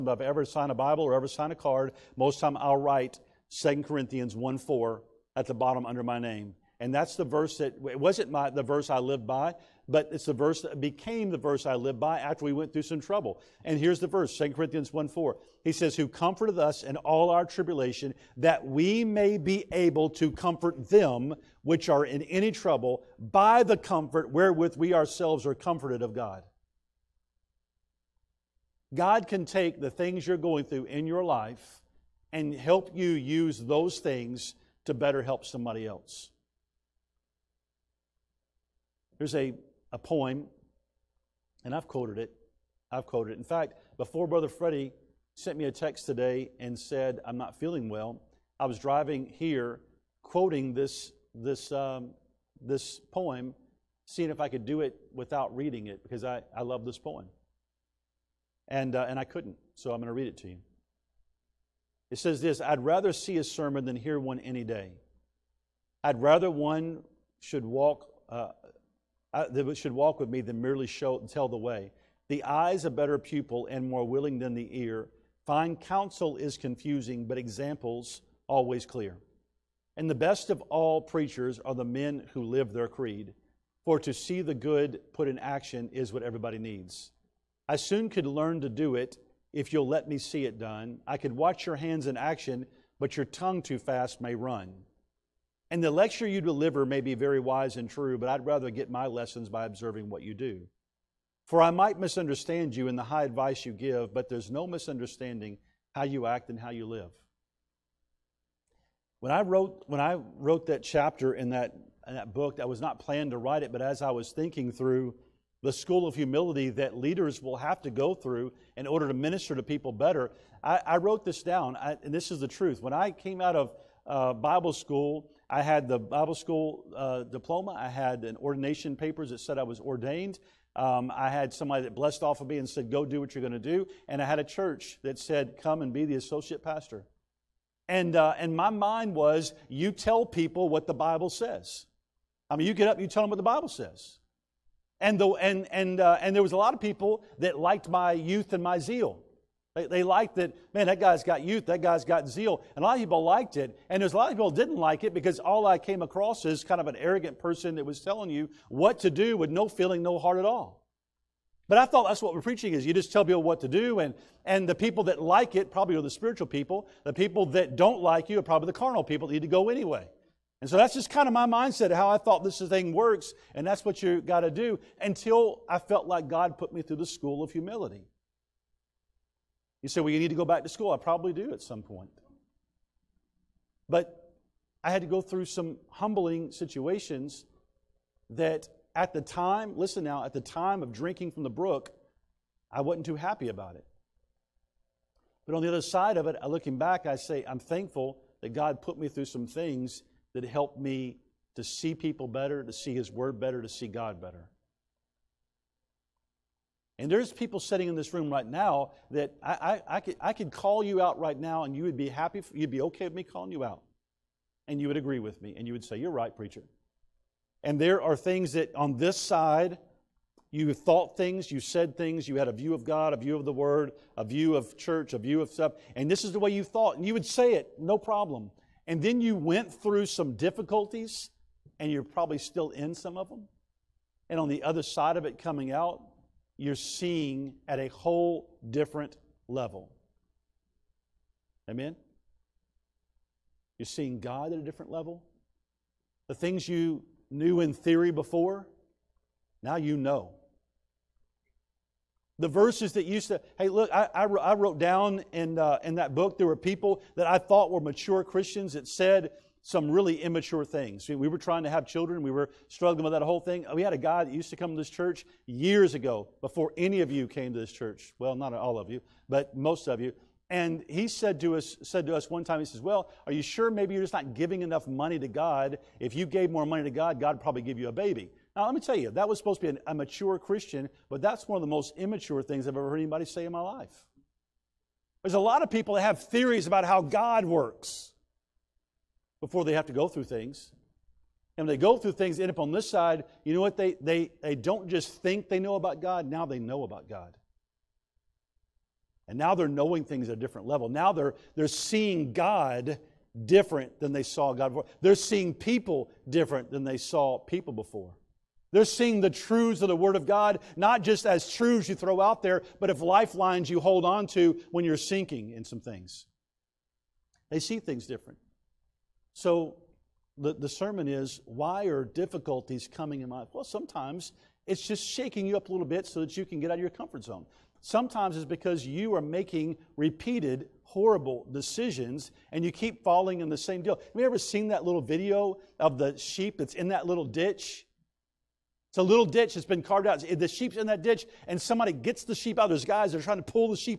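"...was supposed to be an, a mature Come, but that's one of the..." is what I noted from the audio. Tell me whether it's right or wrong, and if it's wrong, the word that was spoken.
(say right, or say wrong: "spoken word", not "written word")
wrong: "Christian", not "Come".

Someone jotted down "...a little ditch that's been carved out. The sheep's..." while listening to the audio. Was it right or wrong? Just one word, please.
right.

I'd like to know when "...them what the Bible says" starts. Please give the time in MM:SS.
02:23.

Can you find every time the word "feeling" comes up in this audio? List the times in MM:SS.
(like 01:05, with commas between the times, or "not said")
00:47, 02:39.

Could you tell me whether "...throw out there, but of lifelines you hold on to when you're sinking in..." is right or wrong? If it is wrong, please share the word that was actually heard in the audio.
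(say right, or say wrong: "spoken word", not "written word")
right.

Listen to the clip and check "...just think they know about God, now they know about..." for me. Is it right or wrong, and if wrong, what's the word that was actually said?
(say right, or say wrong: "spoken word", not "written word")
right.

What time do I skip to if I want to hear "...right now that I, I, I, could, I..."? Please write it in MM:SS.
03:28.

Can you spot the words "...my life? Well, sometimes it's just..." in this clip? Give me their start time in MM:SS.
05:23.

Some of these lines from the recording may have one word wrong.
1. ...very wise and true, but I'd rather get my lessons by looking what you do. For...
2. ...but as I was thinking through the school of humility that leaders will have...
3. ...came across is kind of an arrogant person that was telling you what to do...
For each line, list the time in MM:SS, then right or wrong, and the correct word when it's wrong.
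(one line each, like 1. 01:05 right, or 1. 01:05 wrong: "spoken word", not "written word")
1. 01:37 wrong: "observing", not "looking"
2. 01:53 right
3. 02:35 right.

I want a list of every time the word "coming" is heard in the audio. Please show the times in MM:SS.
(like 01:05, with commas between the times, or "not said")
03:55, 05:22.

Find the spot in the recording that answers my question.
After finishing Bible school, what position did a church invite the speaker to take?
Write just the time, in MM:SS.
02:16.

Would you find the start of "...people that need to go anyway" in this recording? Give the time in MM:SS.
02:49.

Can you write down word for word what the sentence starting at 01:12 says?
The eye's a better pupil and more willing than the ear.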